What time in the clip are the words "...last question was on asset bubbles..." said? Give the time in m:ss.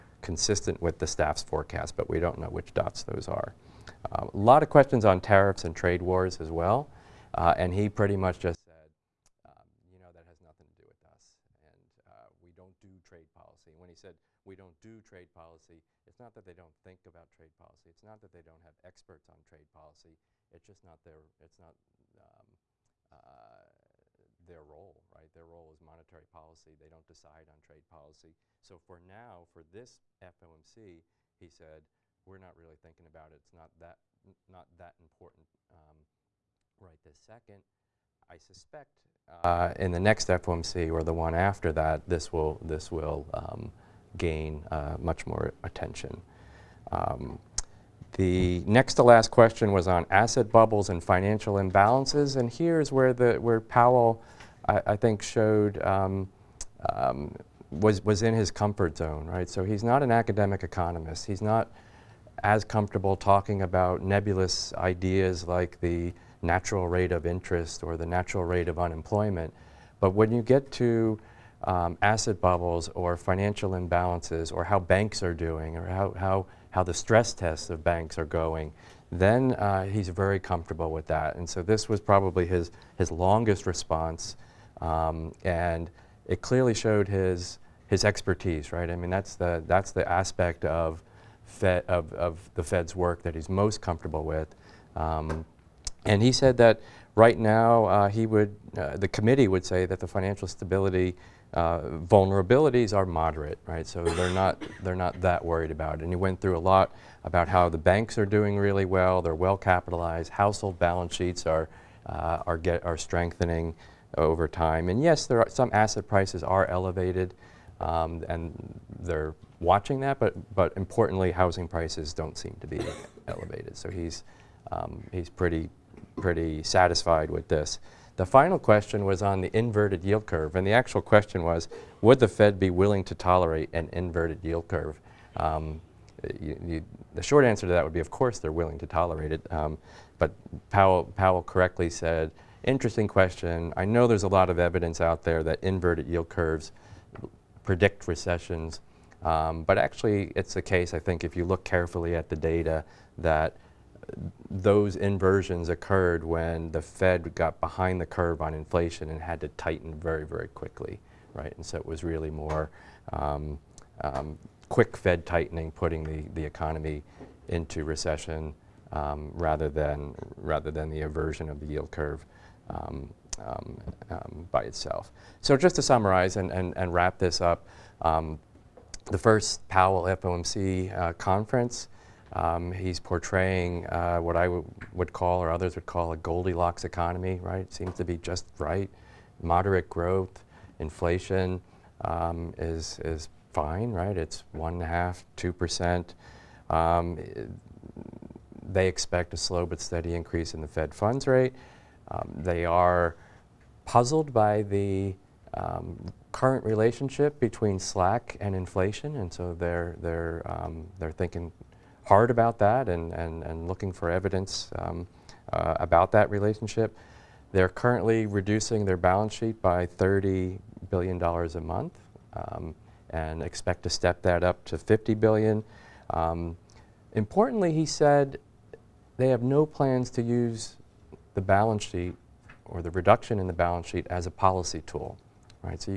0:49.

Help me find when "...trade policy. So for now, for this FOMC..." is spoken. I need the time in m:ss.
0:27.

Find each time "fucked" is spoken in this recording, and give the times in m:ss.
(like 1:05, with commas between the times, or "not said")
not said.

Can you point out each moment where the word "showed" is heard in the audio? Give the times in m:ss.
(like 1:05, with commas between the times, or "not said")
0:55, 1:26.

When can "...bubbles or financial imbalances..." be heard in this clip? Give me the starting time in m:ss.
1:12.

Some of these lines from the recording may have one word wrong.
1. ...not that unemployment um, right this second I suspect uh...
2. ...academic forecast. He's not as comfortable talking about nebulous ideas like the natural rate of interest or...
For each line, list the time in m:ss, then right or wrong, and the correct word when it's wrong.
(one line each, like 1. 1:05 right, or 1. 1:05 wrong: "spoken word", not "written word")
1. 0:34 wrong: "important", not "unemployment"
2. 1:00 wrong: "economist", not "forecast".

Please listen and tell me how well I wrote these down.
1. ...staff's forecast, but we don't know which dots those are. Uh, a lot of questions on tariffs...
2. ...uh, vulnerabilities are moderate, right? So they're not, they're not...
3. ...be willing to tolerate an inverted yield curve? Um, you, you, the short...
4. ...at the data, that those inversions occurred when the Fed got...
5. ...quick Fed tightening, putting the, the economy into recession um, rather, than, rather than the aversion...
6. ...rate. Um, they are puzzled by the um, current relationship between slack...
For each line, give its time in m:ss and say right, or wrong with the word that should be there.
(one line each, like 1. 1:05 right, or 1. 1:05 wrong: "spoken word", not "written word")
1. 0:01 right
2. 1:41 right
3. 2:12 right
4. 2:32 right
5. 2:44 right
6. 3:21 right.